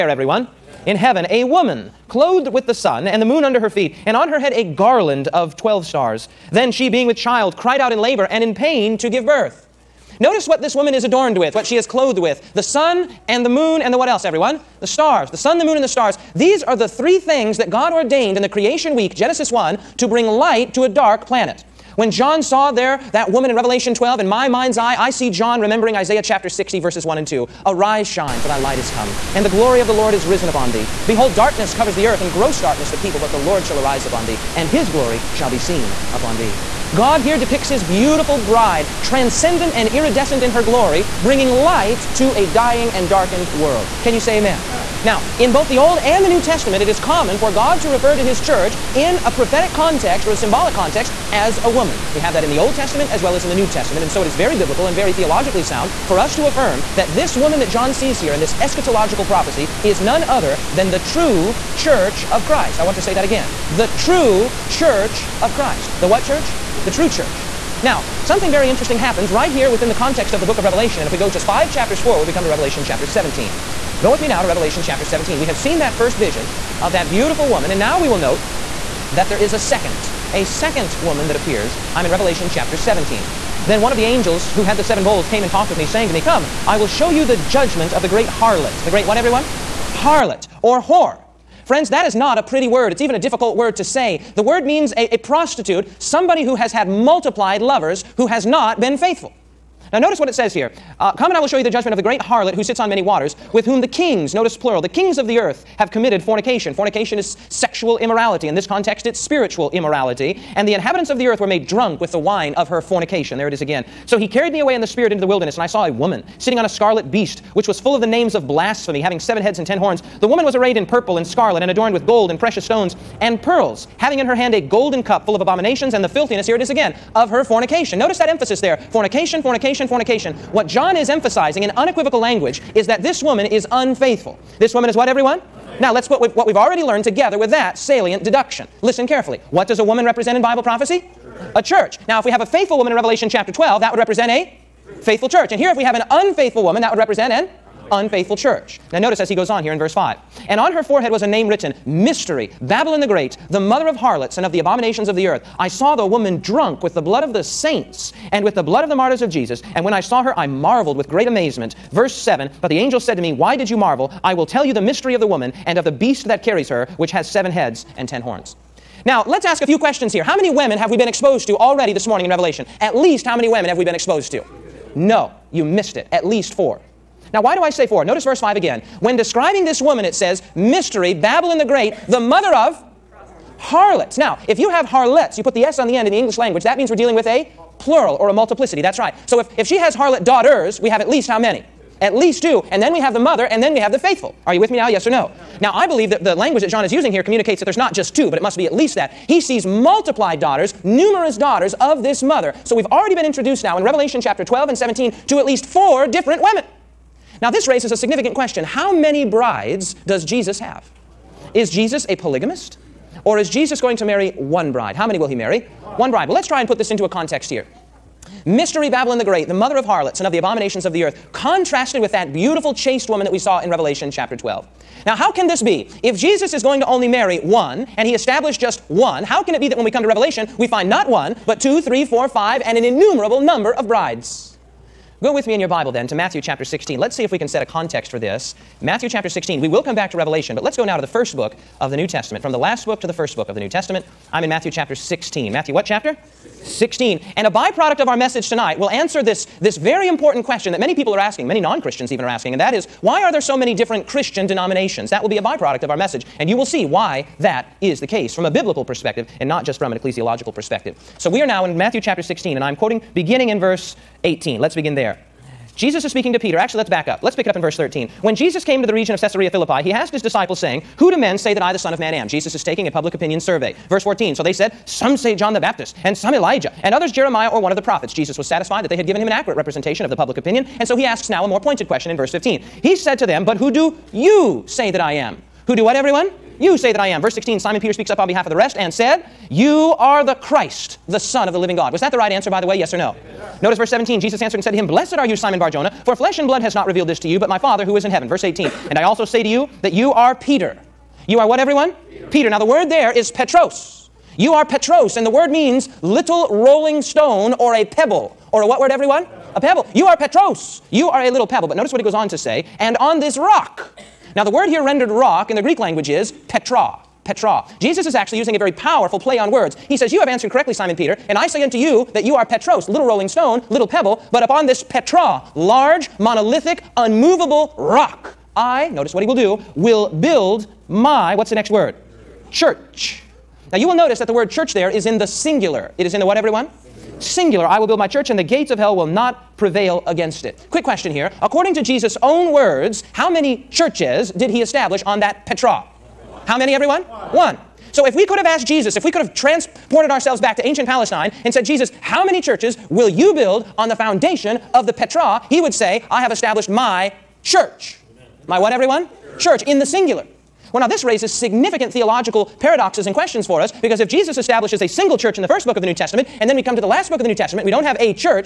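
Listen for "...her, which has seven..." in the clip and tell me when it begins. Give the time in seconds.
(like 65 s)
166 s.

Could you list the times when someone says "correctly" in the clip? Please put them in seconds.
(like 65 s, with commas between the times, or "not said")
320 s.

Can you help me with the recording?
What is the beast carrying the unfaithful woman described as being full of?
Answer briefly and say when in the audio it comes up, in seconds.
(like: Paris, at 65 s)
Names of blasphemy, at 118 s.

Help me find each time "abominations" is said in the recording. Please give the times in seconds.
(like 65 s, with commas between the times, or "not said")
125 s, 154 s, 220 s.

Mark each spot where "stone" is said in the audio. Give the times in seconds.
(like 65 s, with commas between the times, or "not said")
122 s, 307 s, 323 s.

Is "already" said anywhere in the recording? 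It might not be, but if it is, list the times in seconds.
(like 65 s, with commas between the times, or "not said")
136 s, 171 s, 202 s.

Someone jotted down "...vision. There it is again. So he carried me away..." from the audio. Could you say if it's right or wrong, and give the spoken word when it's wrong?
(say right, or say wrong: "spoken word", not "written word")
wrong: "fornication", not "vision".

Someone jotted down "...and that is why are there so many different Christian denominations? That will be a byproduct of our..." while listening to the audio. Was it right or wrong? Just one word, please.
right.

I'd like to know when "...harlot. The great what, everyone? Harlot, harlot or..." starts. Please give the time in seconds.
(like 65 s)
88 s.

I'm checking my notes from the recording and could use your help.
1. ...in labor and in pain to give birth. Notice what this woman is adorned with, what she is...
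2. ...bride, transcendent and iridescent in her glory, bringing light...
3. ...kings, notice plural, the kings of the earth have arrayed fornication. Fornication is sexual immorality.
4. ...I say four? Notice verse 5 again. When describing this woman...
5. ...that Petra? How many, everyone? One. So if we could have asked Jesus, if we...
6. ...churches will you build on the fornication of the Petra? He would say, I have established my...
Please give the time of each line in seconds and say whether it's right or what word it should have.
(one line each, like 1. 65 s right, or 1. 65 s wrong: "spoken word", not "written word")
1. 7 s right
2. 38 s right
3. 103 s wrong: "committed", not "arrayed"
4. 177 s right
5. 345 s right
6. 352 s wrong: "foundation", not "fornication".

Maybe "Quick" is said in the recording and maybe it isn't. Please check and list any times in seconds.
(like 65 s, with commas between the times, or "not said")
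340 s.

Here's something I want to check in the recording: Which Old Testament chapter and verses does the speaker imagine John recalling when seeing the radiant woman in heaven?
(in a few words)
Isaiah 60:1-2.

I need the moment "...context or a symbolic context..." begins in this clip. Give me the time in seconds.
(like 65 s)
49 s.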